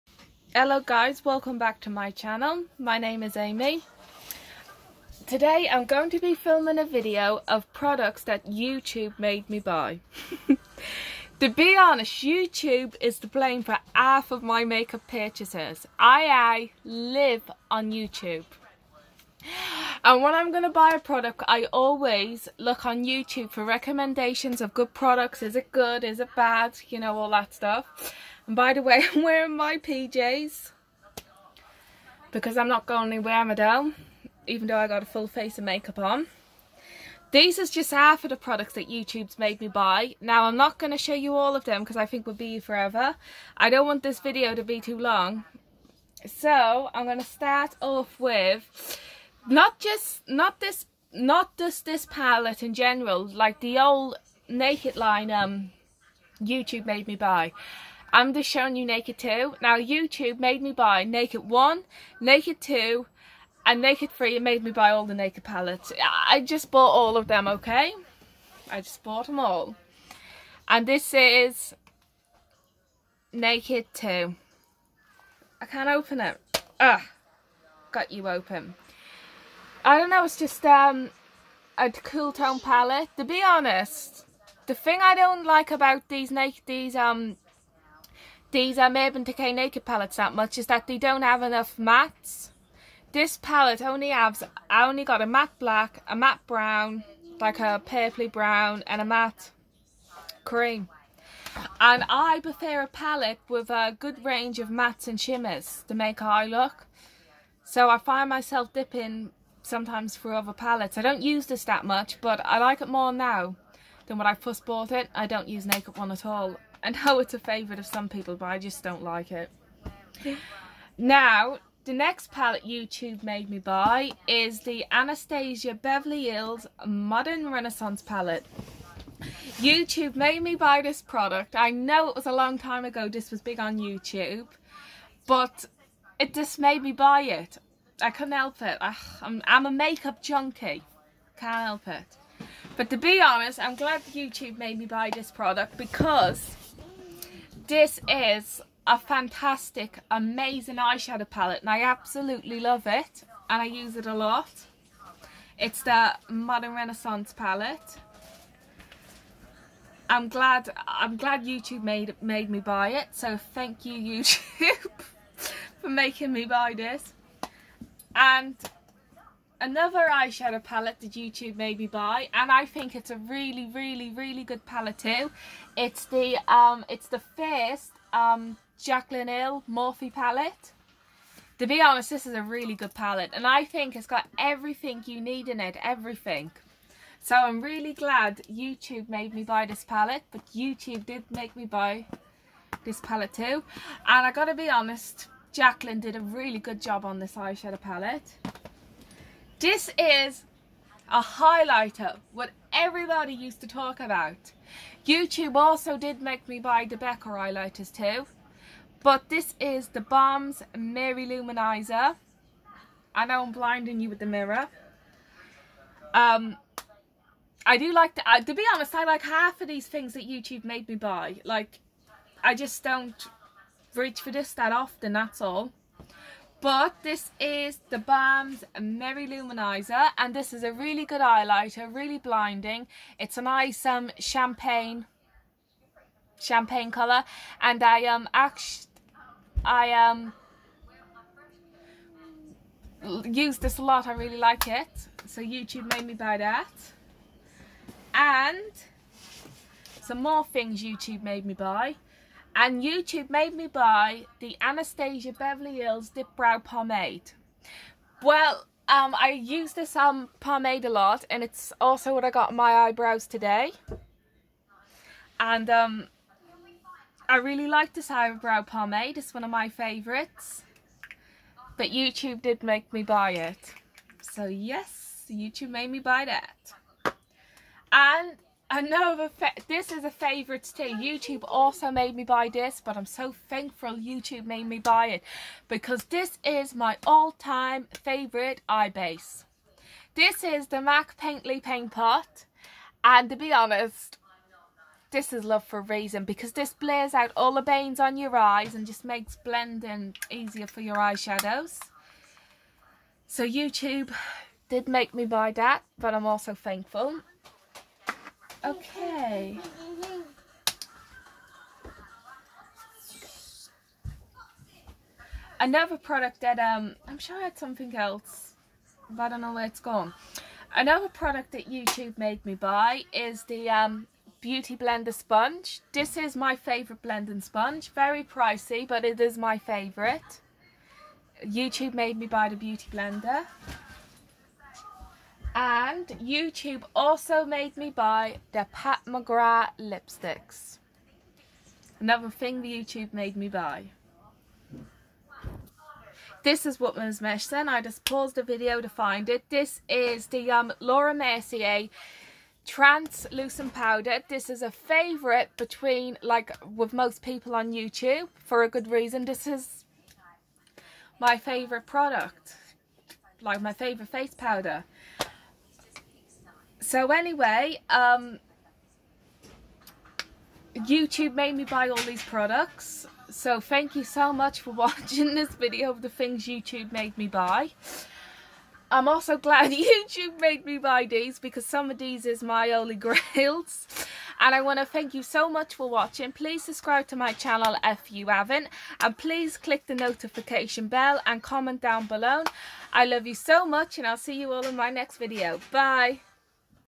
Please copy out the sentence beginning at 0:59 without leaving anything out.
Now YouTube made me buy Naked 1, Naked 2 and Naked 3 and made me buy all the Naked palettes.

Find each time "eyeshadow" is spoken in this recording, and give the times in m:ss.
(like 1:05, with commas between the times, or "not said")
2:30, 2:50, 3:17, 5:00.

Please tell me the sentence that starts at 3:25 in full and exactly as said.
YouTube also did make me buy the Becca highlighters too.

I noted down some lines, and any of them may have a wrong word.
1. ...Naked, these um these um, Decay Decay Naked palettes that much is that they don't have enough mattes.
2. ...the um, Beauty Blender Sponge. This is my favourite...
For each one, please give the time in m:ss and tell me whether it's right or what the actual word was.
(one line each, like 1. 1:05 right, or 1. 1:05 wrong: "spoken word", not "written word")
1. 1:26 wrong: "Urban", not "Decay"
2. 5:23 right.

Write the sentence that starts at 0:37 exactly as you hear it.
These is just half of the products that YouTube's made me buy.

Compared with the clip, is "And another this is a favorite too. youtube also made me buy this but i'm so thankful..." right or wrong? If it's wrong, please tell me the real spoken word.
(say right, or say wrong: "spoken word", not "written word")
right.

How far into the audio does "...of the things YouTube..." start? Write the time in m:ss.
6:15.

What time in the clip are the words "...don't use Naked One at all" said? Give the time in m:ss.
1:55.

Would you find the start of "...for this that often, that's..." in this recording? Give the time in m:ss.
3:44.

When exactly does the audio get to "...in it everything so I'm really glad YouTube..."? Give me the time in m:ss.
3:05.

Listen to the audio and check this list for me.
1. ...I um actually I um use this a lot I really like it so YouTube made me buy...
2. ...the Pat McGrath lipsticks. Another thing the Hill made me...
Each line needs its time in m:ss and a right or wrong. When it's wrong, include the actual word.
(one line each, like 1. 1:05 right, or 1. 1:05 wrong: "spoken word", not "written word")
1. 3:57 right
2. 5:38 wrong: "YouTube", not "Hill".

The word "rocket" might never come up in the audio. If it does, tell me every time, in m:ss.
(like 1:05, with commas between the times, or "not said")
not said.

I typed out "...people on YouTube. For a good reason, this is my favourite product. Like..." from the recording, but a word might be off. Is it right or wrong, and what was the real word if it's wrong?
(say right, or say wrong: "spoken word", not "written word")
right.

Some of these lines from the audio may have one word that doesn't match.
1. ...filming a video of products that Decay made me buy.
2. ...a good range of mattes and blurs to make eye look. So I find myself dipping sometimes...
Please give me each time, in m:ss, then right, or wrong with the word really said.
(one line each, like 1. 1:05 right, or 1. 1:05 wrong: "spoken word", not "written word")
1. 0:06 wrong: "YouTube", not "Decay"
2. 1:43 wrong: "shimmers", not "blurs".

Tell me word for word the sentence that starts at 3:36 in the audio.
Um, I do like, the, to be honest, I like half of these things that YouTube made me buy.